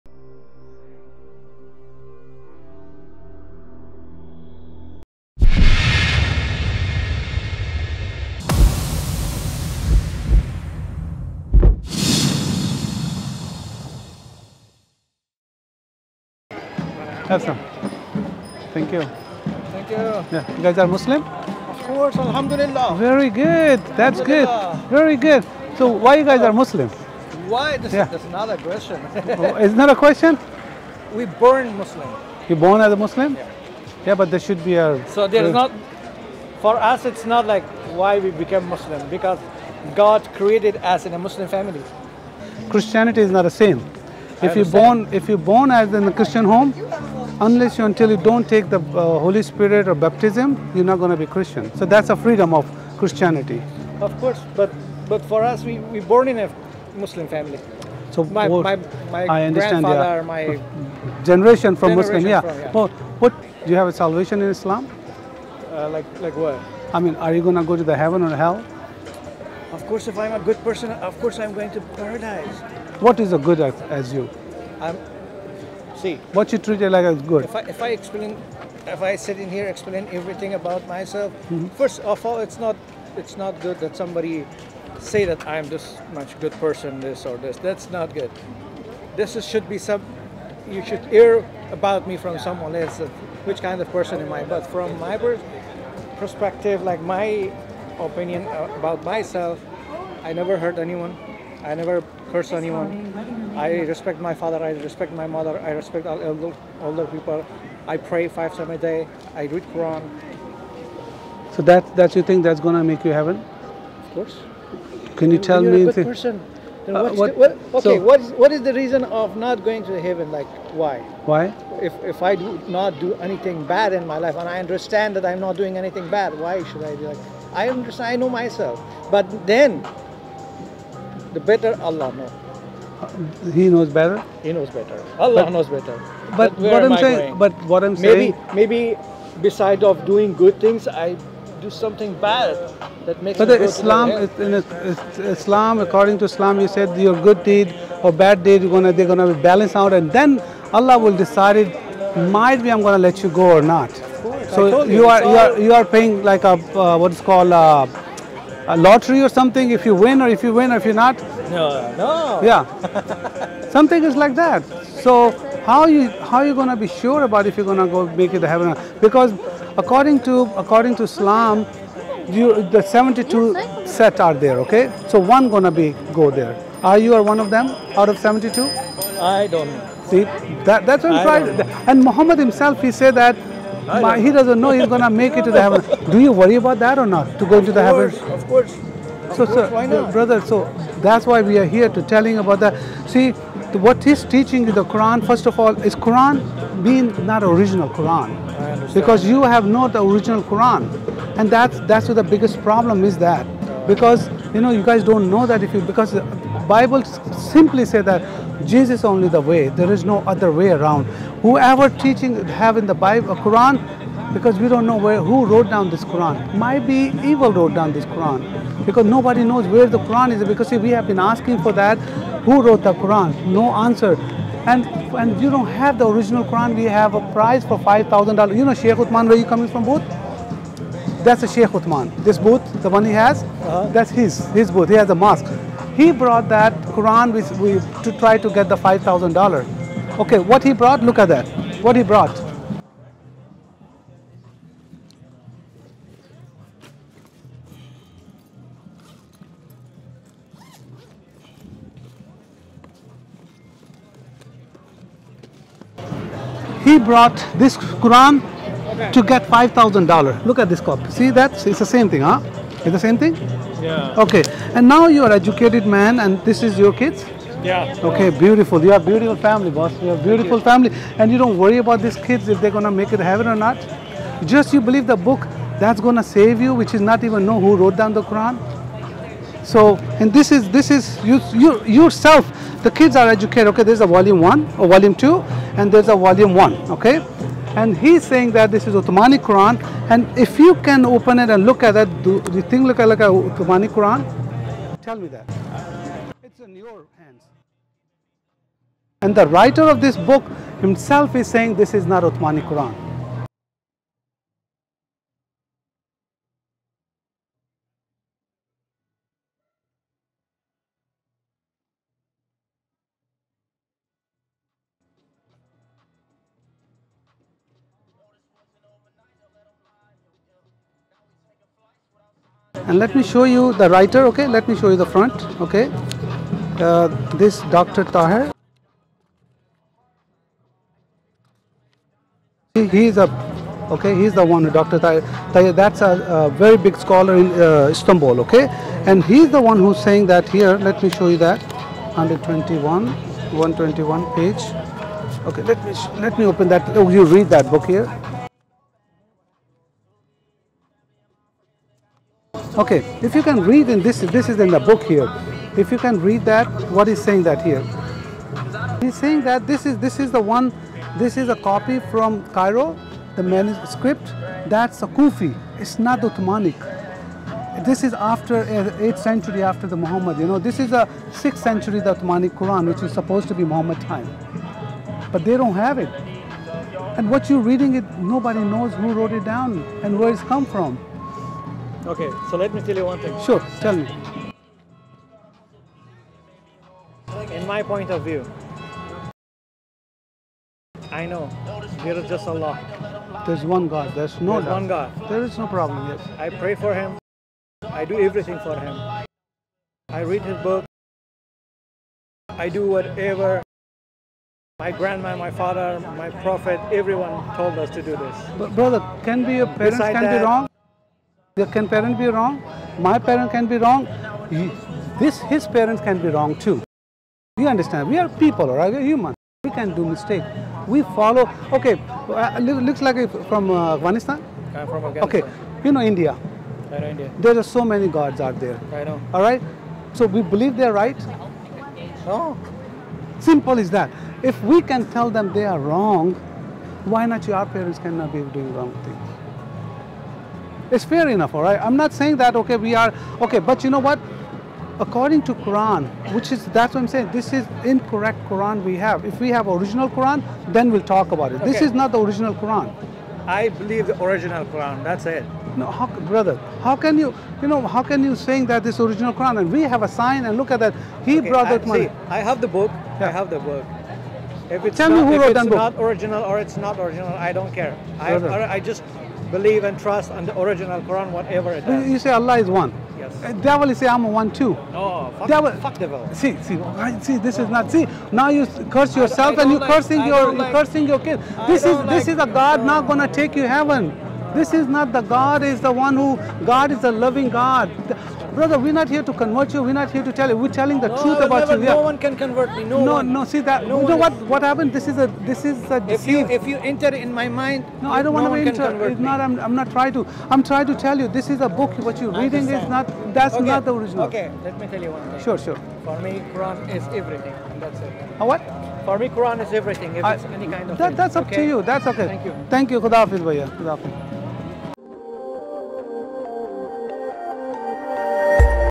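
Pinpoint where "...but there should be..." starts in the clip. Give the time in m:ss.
0:34.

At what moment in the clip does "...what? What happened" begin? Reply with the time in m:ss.
8:14.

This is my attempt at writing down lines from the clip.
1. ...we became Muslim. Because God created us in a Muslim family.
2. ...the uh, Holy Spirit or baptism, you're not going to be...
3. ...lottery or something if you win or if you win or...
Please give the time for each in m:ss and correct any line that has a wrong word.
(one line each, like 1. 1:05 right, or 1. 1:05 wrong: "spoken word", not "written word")
1. 0:38 right
2. 0:48 right
3. 2:38 right.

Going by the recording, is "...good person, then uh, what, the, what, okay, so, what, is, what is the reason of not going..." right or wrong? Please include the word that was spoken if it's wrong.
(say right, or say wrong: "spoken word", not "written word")
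right.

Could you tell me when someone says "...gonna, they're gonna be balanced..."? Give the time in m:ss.
2:28.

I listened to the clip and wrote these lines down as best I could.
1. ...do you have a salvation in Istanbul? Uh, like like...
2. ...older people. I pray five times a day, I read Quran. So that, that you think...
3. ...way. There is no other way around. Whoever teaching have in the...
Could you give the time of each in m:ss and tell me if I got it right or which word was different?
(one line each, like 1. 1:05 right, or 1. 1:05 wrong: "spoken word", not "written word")
1. 1:03 wrong: "Islam", not "Istanbul"
2. 1:46 right
3. 3:29 right.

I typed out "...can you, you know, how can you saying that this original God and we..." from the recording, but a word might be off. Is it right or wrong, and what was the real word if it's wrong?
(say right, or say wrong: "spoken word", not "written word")
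wrong: "Quran", not "God".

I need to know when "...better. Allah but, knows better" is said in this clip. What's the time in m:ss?
2:14.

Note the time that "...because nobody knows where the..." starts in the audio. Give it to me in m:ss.
3:38.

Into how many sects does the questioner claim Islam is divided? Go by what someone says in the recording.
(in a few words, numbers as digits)
72.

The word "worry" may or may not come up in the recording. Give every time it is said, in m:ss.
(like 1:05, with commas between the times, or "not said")
3:06, 4:31.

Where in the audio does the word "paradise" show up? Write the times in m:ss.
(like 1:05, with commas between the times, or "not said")
1:11.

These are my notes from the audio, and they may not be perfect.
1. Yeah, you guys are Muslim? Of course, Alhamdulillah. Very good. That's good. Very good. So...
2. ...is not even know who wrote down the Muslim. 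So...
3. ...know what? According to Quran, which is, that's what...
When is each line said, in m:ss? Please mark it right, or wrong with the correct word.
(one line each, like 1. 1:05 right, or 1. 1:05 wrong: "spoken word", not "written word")
1. 0:20 right
2. 4:36 wrong: "Quran", not "Muslim"
3. 7:23 right.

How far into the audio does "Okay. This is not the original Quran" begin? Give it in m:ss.
7:31.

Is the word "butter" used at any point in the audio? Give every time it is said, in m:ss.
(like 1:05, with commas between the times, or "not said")
not said.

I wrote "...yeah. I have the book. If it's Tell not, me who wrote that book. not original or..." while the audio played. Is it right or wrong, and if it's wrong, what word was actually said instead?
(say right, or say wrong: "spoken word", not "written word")
right.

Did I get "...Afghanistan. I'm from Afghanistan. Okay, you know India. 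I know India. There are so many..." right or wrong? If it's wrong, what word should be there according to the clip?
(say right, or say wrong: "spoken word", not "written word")
right.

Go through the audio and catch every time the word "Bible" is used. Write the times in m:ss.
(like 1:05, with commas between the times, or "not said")
3:26, 3:32.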